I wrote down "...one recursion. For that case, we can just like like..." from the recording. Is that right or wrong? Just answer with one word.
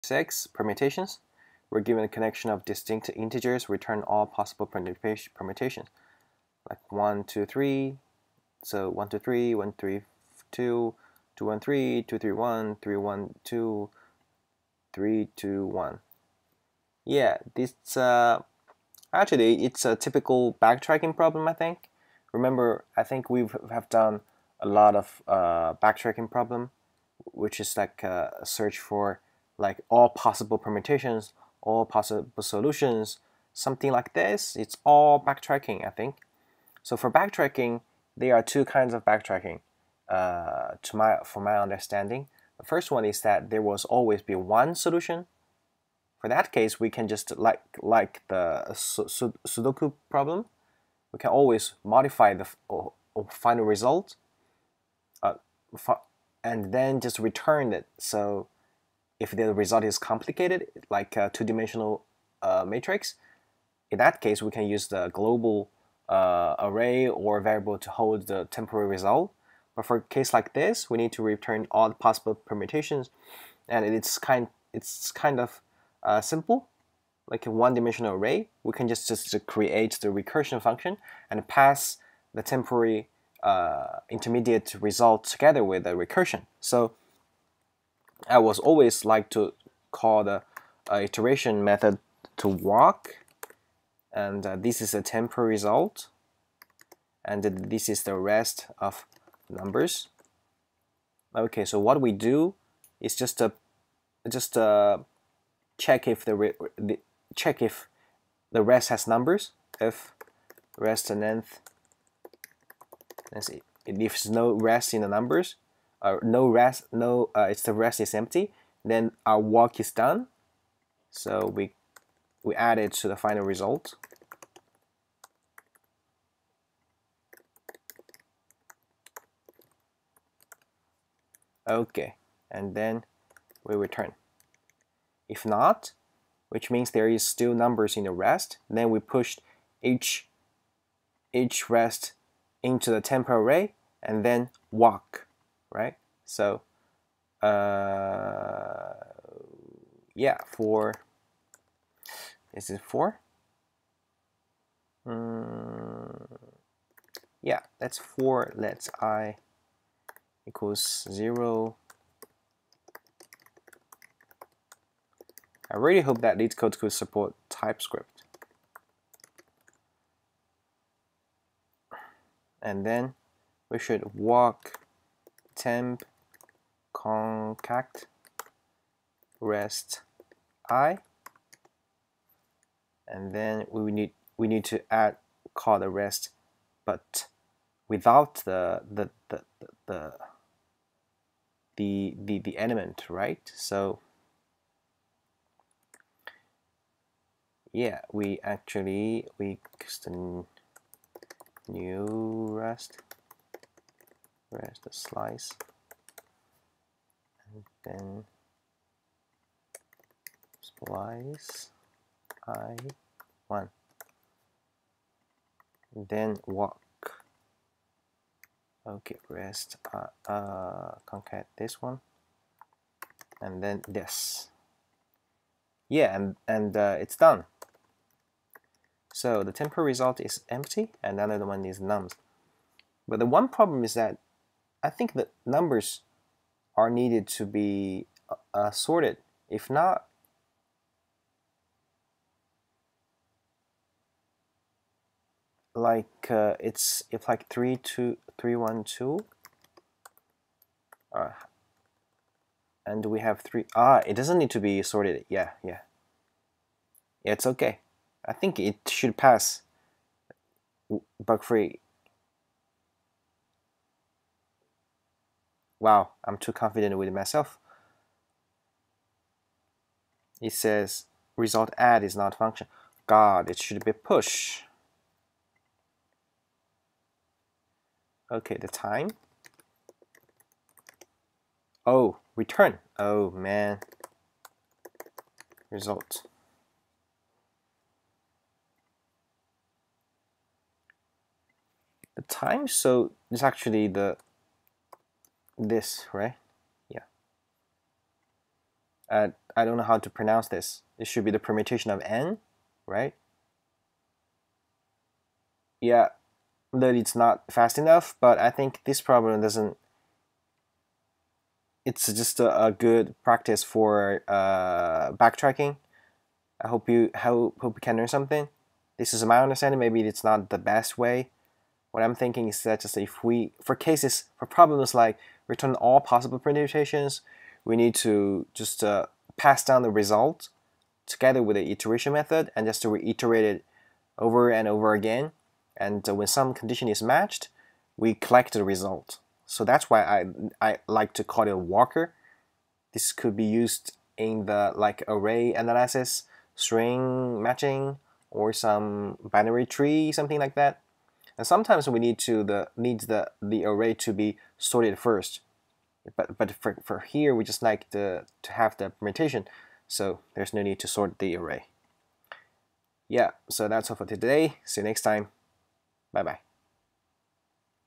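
wrong.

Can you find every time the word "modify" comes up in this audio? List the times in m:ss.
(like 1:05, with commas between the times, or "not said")
0:51.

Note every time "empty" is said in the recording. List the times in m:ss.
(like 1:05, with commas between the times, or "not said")
1:58, 3:50.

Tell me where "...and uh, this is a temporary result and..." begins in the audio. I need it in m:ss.
1:34.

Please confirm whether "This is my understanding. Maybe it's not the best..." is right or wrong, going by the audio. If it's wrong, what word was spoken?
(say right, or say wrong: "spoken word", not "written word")
right.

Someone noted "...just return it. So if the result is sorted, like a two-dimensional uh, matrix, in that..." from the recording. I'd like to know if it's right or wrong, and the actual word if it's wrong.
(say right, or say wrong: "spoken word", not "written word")
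wrong: "complicated", not "sorted".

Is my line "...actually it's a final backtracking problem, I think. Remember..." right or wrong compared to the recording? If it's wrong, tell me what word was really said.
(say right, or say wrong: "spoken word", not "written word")
wrong: "typical", not "final".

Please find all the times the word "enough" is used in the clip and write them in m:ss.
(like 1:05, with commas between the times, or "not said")
5:07.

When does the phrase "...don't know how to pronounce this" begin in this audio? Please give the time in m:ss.
4:59.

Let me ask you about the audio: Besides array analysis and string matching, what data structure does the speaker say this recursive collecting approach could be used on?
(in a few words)
binary tree.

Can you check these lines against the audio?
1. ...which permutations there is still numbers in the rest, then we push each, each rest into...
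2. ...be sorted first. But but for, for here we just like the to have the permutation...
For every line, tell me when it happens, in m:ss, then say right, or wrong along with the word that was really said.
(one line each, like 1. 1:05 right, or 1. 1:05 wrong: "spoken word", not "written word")
1. 2:16 wrong: "means", not "permutations"
2. 5:54 right.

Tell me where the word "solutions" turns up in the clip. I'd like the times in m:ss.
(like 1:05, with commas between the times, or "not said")
0:32, 0:44.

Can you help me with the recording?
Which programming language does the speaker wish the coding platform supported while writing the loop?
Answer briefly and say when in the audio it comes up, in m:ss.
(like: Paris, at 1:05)
TypeScript, at 2:47.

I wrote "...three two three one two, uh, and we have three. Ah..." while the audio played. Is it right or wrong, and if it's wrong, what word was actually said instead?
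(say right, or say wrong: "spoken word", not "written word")
right.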